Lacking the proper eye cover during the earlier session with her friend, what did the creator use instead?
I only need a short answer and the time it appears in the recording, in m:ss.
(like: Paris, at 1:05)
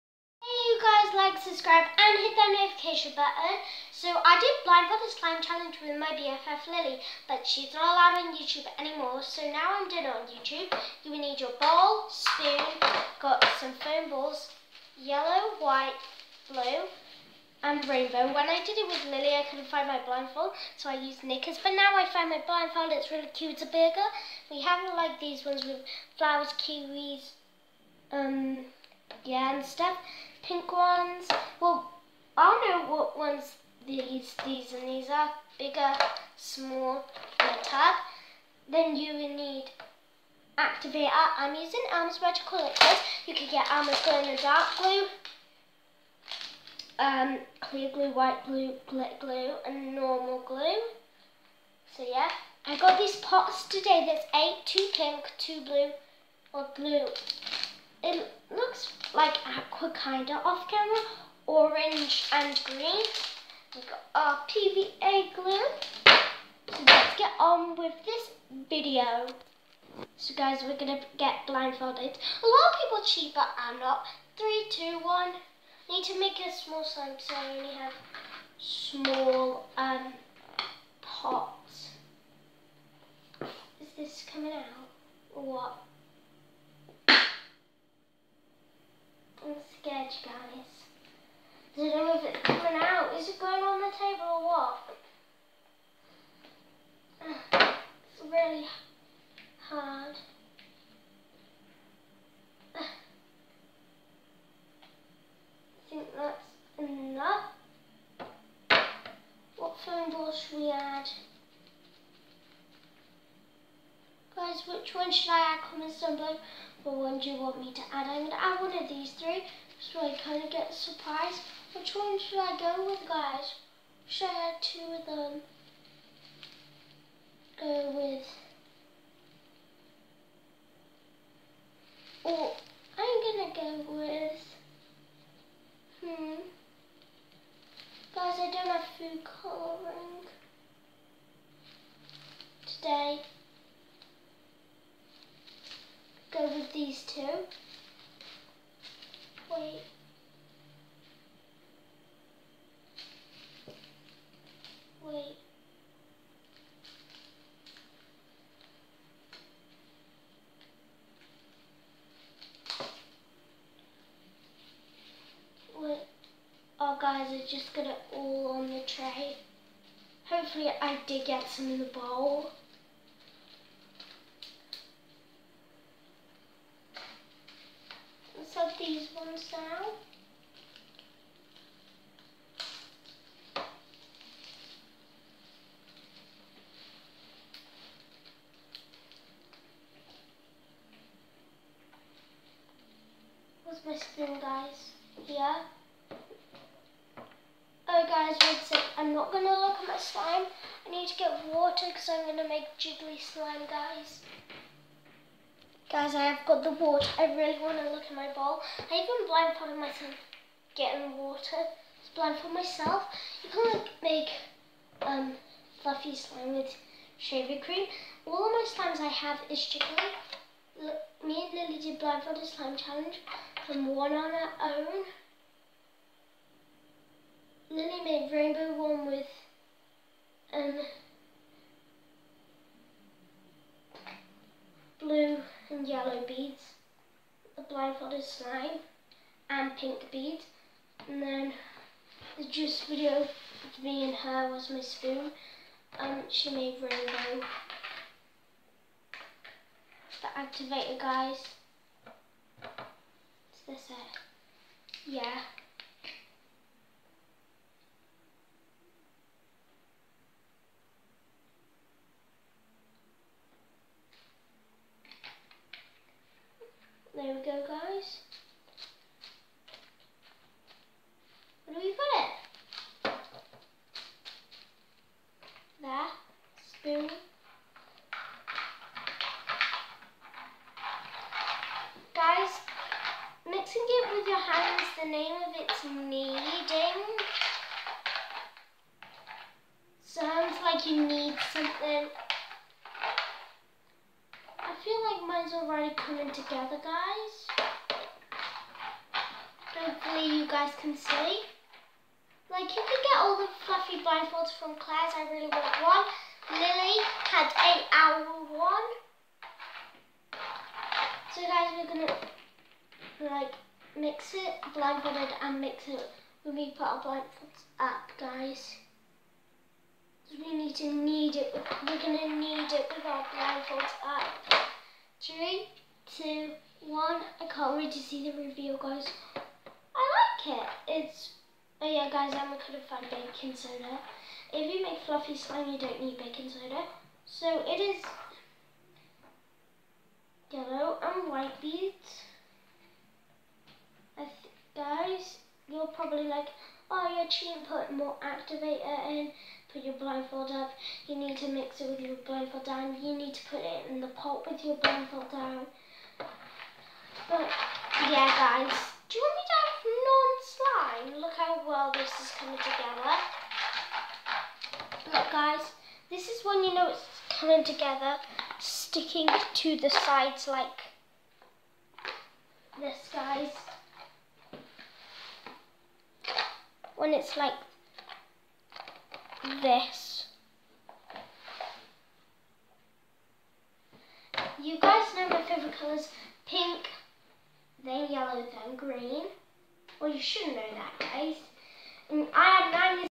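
knickers, at 0:21.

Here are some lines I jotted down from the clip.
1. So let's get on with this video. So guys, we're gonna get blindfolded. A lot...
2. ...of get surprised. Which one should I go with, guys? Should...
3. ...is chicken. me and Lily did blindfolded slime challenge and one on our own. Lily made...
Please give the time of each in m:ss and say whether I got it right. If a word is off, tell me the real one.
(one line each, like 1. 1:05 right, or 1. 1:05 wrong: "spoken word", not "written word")
1. 1:06 right
2. 2:00 right
3. 3:39 right.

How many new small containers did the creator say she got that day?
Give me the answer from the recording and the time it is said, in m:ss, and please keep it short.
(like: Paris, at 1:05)
8, at 0:54.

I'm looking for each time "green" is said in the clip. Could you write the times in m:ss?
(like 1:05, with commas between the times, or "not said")
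1:02, 6:28.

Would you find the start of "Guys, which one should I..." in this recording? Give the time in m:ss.
1:54.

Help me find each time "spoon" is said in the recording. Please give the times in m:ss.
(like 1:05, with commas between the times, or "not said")
0:12, 4:04.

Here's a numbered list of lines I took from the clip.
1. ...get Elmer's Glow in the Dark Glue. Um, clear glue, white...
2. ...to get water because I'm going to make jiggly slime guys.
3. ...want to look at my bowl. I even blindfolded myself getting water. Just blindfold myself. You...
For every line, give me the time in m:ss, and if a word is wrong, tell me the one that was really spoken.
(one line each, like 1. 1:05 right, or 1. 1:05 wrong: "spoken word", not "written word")
1. 0:43 right
2. 3:21 right
3. 3:27 right.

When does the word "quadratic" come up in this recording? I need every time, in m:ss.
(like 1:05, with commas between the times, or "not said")
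not said.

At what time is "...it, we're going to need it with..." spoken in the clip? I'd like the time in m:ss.
5:21.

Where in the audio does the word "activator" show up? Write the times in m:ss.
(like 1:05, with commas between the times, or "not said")
0:40, 4:10, 5:48.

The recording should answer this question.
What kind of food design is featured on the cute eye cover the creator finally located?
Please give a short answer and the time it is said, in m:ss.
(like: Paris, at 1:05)
a burger, at 0:23.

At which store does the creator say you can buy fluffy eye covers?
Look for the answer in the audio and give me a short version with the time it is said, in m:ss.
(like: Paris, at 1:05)
Claire's, at 5:04.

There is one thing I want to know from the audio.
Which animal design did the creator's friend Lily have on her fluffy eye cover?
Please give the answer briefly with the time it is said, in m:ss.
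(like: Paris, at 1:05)
owl, at 5:07.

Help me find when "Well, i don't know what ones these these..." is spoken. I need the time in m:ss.
0:31.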